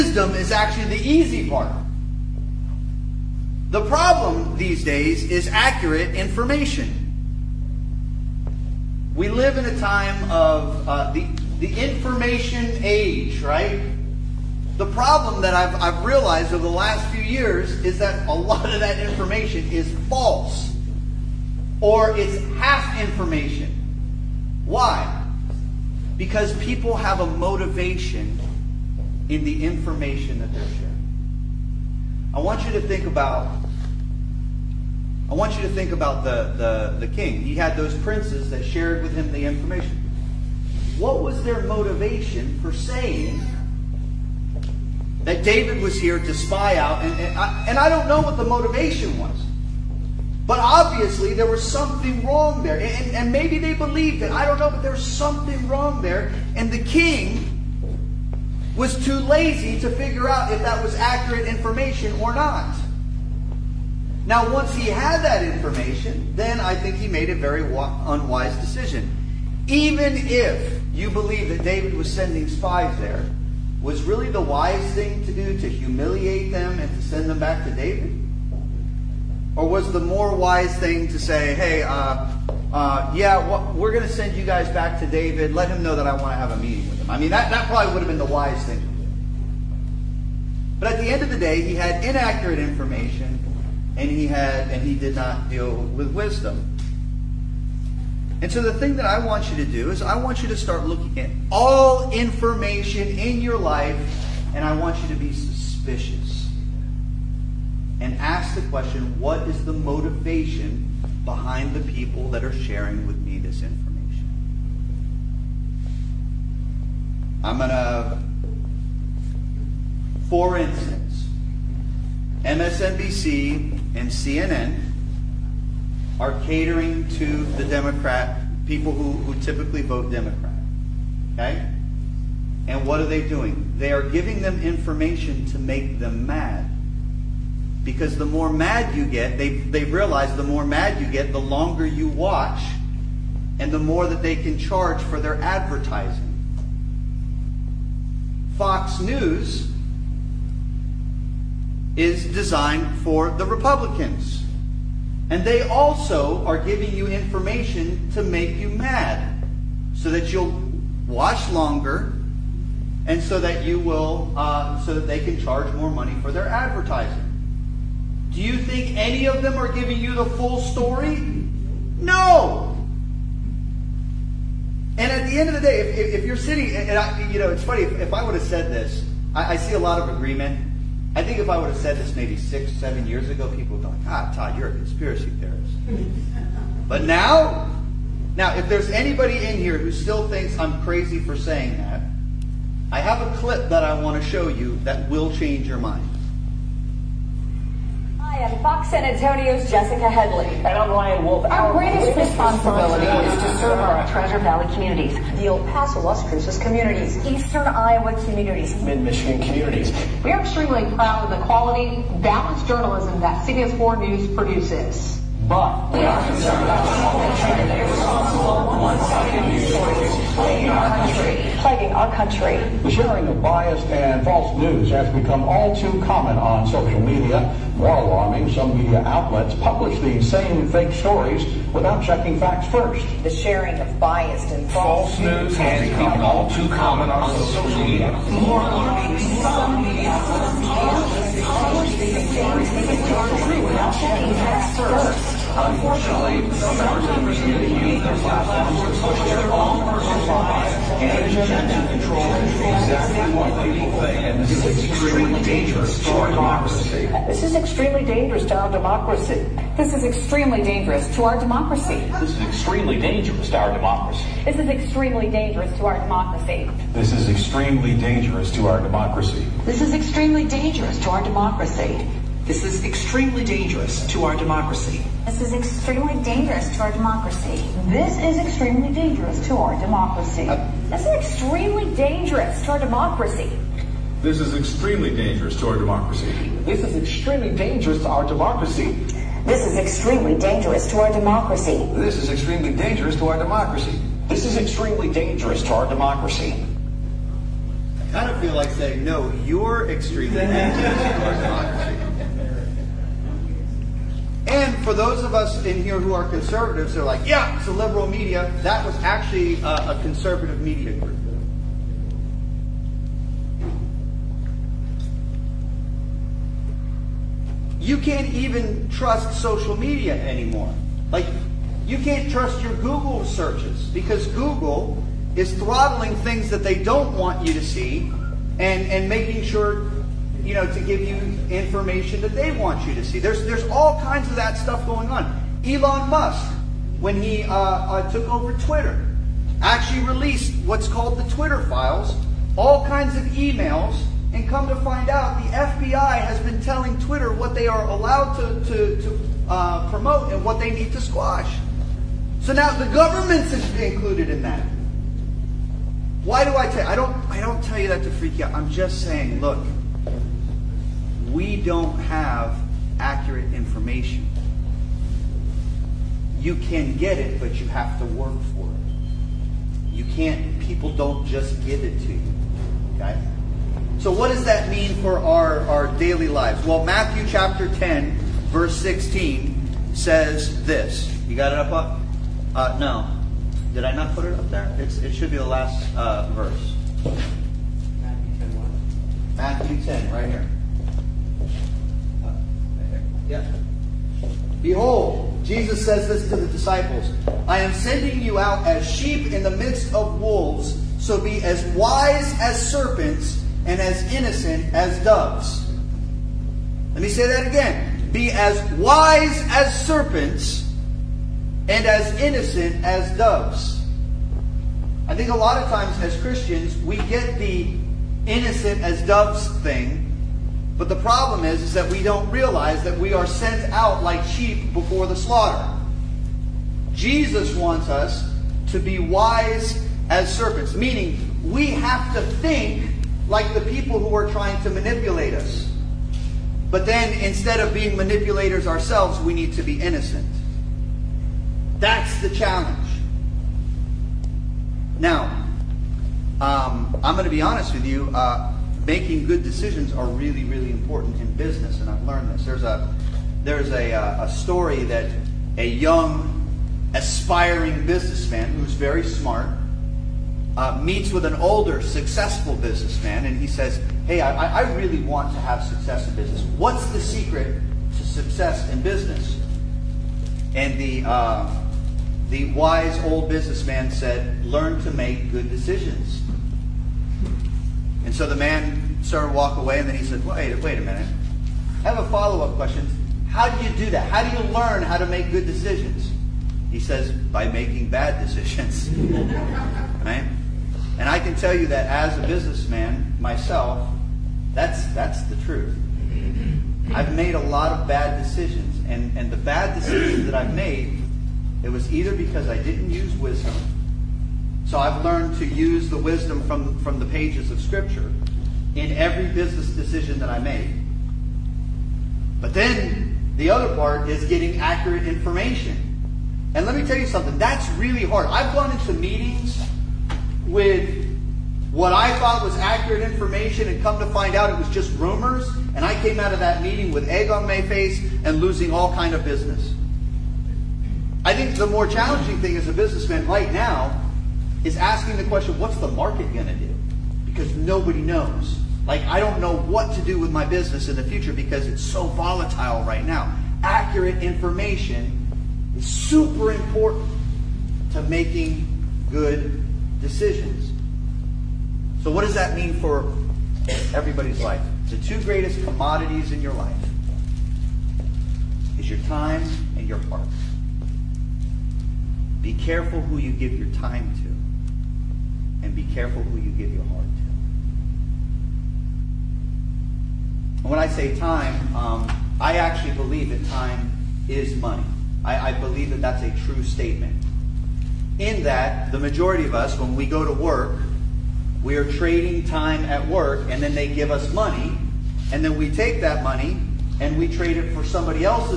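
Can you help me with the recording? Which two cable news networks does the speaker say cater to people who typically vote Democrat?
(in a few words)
MSNBC and CNN.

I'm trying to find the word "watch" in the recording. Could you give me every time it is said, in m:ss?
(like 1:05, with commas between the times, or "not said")
2:22, 2:41.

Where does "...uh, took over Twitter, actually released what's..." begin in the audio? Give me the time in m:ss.
5:37.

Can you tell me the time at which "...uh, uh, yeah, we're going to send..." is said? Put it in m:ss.
1:21.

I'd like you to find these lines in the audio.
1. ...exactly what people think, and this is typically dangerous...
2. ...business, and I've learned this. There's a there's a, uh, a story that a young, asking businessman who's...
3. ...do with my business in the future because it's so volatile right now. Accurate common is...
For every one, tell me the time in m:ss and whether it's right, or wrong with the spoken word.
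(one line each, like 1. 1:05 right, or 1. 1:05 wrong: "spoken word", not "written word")
1. 4:12 wrong: "extremely", not "typically"
2. 7:31 wrong: "aspiring", not "asking"
3. 9:00 wrong: "information", not "common".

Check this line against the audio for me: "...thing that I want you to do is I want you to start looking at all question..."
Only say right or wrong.
wrong.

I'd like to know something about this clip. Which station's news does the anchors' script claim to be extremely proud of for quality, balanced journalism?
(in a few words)
CBS4 News.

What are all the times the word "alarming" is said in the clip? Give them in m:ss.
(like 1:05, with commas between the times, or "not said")
3:47, 3:58.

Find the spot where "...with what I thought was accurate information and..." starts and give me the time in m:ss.
8:40.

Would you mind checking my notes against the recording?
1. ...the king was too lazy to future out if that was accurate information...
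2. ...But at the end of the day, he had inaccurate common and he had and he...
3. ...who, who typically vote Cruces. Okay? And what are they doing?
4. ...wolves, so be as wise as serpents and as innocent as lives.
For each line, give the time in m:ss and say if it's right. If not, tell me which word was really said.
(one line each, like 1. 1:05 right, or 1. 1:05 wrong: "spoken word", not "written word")
1. 0:56 wrong: "figure", not "future"
2. 1:30 wrong: "information", not "common"
3. 2:08 wrong: "Democrat", not "Cruces"
4. 6:40 wrong: "doves", not "lives".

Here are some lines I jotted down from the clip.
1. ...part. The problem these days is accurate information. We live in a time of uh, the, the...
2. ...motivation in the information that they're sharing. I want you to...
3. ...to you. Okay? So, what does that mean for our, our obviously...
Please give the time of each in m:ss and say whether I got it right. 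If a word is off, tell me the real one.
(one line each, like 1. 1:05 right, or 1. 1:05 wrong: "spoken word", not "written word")
1. 0:01 right
2. 0:27 right
3. 6:12 wrong: "daily", not "obviously".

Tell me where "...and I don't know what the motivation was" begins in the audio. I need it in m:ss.
0:47.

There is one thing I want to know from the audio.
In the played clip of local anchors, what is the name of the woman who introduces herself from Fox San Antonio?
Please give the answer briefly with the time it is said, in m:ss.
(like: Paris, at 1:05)
Jessica Headley, at 3:19.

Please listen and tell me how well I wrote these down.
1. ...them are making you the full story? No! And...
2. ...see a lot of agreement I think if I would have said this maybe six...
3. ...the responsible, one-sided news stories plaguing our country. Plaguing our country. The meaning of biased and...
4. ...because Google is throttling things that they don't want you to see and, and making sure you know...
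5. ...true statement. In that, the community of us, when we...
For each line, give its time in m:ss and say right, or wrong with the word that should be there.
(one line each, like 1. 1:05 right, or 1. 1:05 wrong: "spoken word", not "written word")
1. 2:49 wrong: "giving", not "making"
2. 2:59 right
3. 3:37 wrong: "sharing", not "meaning"
4. 5:23 right
5. 9:36 wrong: "majority", not "community".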